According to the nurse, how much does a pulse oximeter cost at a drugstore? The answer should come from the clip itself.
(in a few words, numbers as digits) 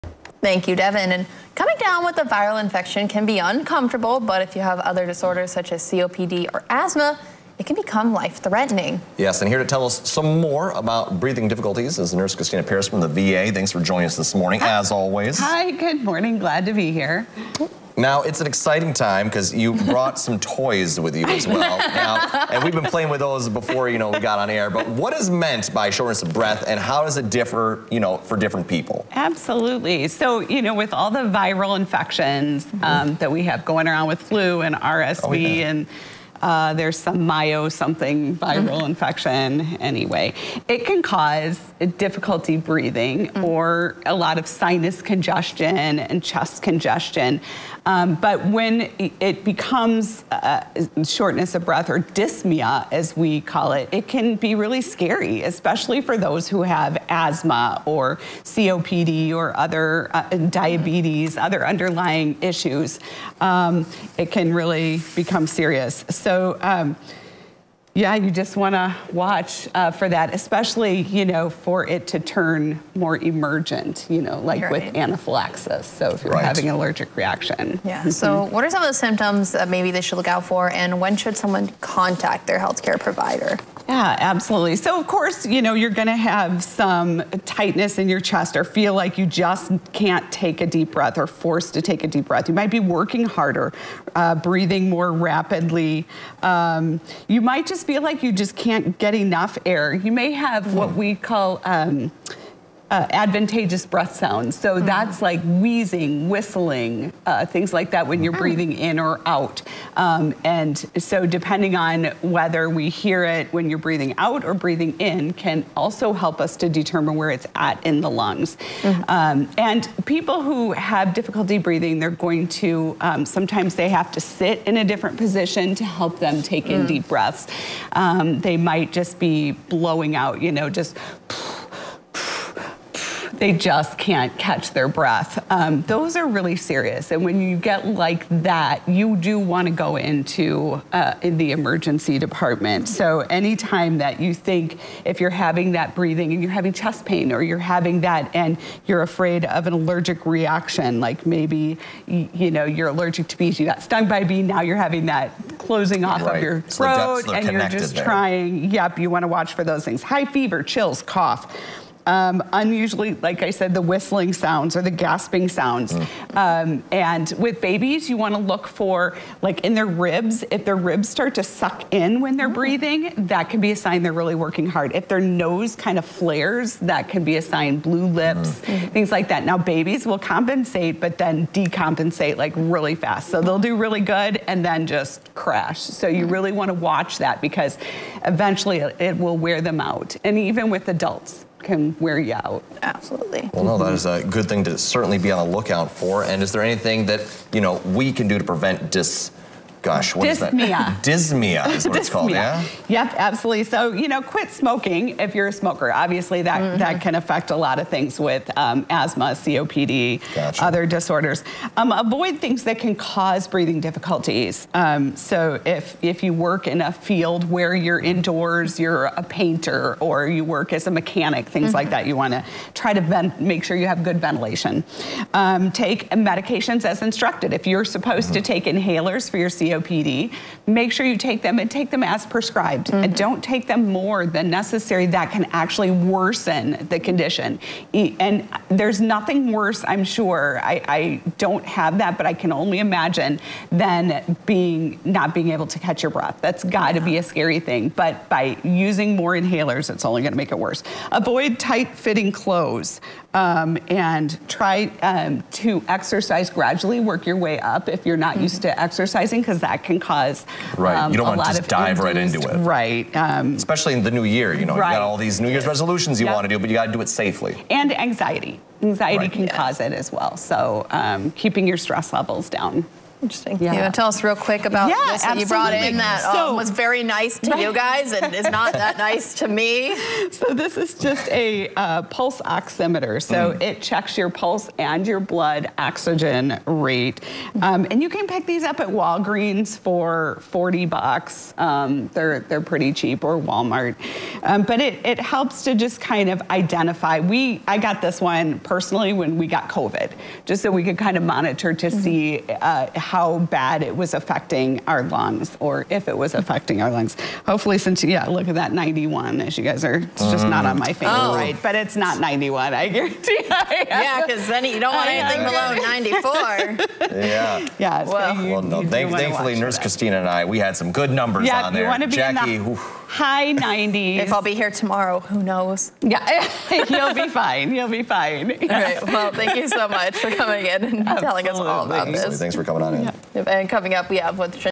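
$40.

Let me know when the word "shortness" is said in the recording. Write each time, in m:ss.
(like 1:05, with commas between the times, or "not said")
0:25, 0:51.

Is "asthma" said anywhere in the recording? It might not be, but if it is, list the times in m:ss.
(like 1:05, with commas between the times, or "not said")
0:06, 0:57, 3:28.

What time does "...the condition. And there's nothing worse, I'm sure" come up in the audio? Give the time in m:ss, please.
3:56.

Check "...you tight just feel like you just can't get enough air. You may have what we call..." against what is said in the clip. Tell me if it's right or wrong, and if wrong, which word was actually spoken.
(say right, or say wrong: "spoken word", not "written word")
wrong: "might", not "tight".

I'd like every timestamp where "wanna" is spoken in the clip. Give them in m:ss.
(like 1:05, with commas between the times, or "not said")
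2:48, 3:06.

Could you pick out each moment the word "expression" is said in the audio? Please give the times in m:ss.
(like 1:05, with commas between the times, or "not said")
not said.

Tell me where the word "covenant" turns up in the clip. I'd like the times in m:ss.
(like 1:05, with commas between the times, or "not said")
not said.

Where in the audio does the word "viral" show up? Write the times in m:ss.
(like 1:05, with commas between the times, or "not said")
0:02, 0:31, 0:38.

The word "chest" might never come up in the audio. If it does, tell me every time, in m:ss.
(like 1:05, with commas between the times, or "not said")
0:46, 1:28, 2:26.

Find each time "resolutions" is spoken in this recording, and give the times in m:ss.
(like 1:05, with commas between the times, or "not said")
4:25.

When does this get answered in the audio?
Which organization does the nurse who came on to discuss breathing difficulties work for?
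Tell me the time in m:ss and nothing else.
0:13.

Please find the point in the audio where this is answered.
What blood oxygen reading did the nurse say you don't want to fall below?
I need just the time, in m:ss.
5:17.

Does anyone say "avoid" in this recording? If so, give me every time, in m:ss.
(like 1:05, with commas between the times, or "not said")
3:31, 4:11.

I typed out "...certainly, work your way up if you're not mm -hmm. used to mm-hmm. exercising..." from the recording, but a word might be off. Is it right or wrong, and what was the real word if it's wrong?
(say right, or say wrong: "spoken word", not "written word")
wrong: "gradually", not "certainly".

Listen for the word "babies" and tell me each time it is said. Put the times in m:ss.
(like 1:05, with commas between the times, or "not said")
2:47, 2:59.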